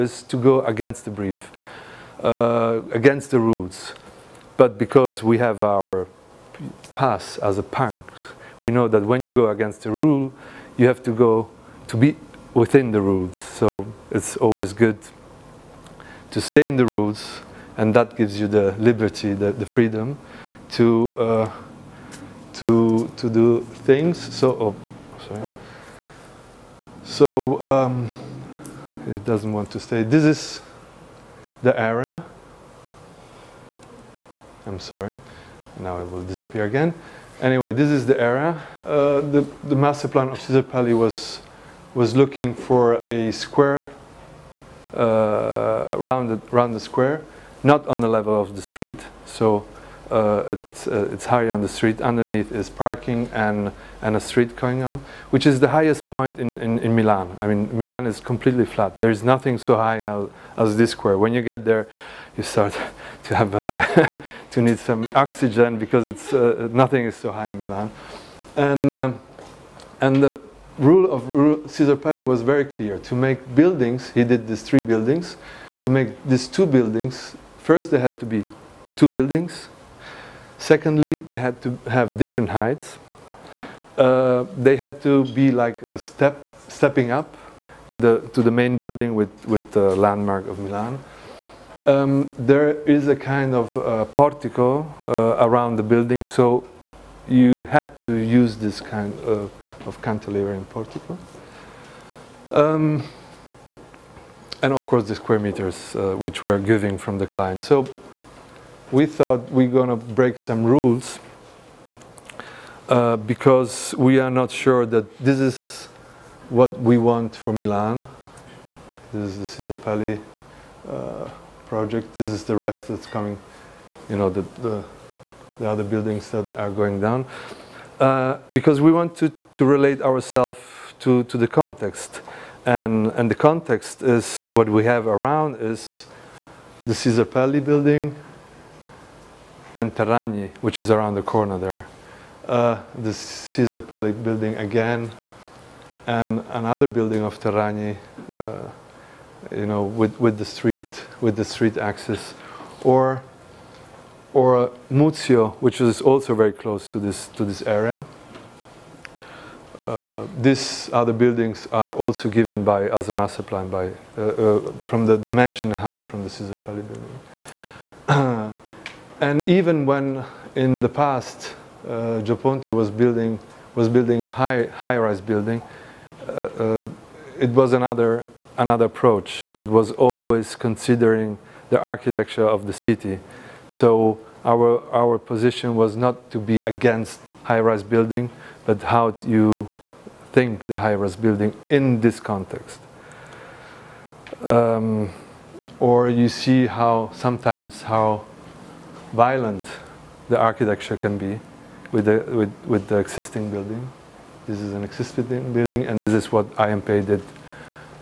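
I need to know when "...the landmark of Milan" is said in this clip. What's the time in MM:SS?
01:29.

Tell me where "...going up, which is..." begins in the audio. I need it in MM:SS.
00:54.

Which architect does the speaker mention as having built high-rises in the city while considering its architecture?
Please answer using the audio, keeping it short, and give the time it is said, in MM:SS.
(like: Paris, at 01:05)
Gio Ponti, at 02:52.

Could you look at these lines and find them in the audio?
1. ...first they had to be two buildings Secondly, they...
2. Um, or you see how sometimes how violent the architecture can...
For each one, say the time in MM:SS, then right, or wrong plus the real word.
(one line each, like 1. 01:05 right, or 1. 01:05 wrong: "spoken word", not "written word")
1. 01:17 right
2. 03:14 right.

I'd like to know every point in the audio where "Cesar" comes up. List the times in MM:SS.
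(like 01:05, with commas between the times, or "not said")
00:40, 01:11, 01:59, 02:16.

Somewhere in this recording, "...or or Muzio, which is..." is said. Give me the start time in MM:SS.
02:32.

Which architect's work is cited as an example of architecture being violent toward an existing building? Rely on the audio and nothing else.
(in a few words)
I.M. Pei.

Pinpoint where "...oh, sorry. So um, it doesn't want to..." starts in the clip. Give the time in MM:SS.
00:24.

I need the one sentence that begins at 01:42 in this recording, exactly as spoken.
Um, and of course the square meters uh, which were giving from the client.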